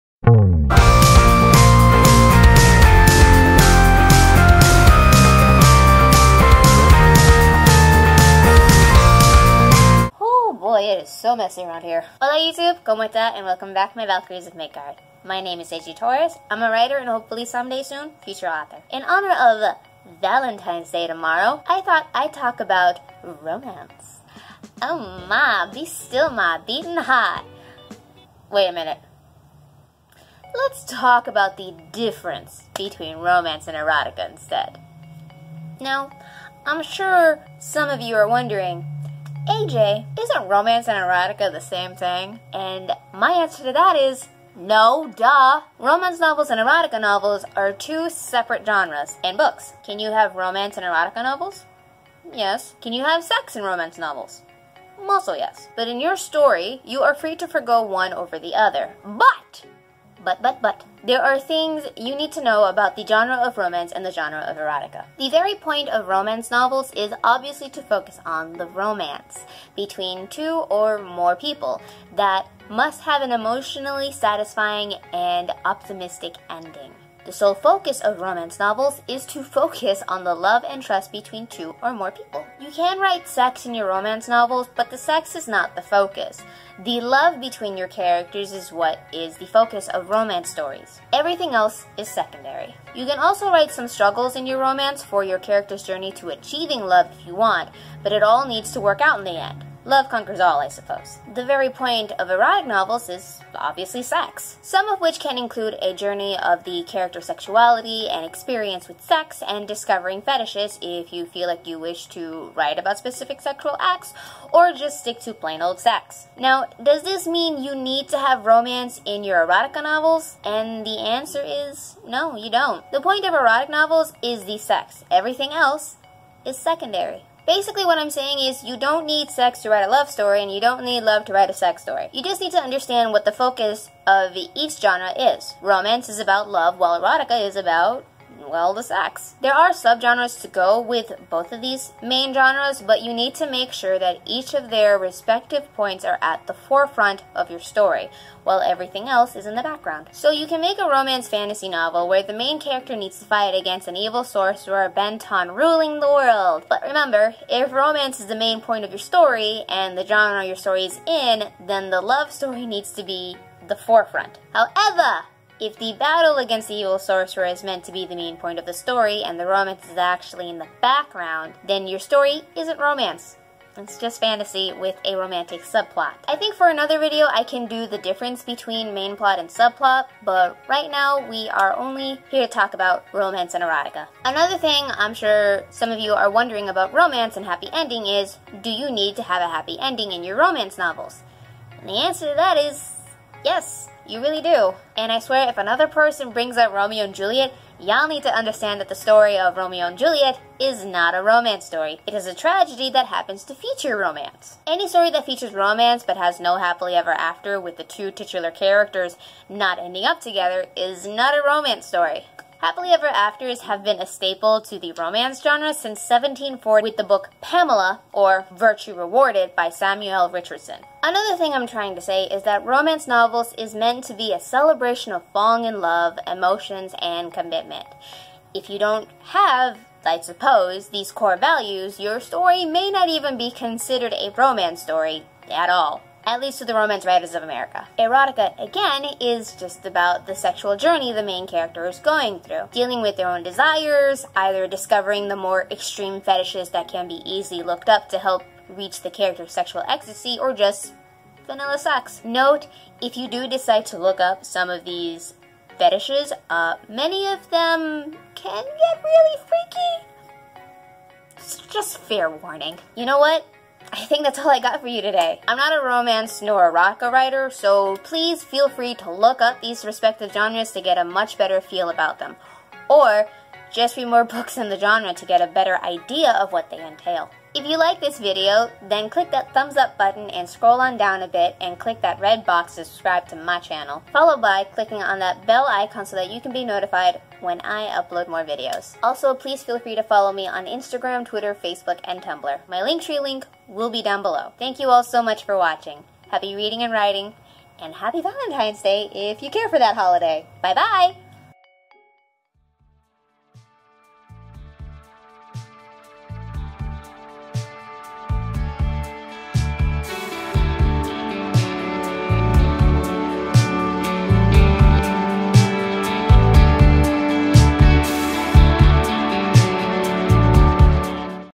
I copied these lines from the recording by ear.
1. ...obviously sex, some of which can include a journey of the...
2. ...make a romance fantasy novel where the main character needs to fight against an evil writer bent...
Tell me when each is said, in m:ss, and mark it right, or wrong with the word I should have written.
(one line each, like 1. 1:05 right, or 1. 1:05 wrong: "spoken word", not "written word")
1. 1:43 right
2. 2:30 wrong: "sorcerer", not "writer".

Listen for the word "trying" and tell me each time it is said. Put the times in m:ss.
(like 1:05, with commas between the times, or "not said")
3:41.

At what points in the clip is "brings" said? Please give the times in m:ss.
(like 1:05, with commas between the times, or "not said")
3:16.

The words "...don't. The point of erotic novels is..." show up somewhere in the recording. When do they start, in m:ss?
2:02.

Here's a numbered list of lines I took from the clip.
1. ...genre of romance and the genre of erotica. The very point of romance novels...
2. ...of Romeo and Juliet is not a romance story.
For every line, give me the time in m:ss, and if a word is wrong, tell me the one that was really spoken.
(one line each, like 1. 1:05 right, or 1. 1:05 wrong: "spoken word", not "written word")
1. 1:03 right
2. 3:19 right.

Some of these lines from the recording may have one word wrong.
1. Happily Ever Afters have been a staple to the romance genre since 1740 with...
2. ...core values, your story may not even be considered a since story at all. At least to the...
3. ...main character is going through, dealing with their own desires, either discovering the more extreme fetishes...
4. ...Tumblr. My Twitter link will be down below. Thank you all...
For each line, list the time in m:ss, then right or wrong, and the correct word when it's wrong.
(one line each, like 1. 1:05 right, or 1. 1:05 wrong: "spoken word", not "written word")
1. 3:32 right
2. 3:51 wrong: "romance", not "since"
3. 4:01 right
4. 4:52 wrong: "Linktree", not "Twitter".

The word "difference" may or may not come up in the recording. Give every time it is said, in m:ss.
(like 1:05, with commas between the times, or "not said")
0:31, 2:57.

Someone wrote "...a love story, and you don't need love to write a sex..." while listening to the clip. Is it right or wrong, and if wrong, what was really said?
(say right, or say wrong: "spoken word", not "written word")
right.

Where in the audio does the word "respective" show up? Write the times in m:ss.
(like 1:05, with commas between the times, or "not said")
2:24, 4:29.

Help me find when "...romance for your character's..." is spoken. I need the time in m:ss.
1:34.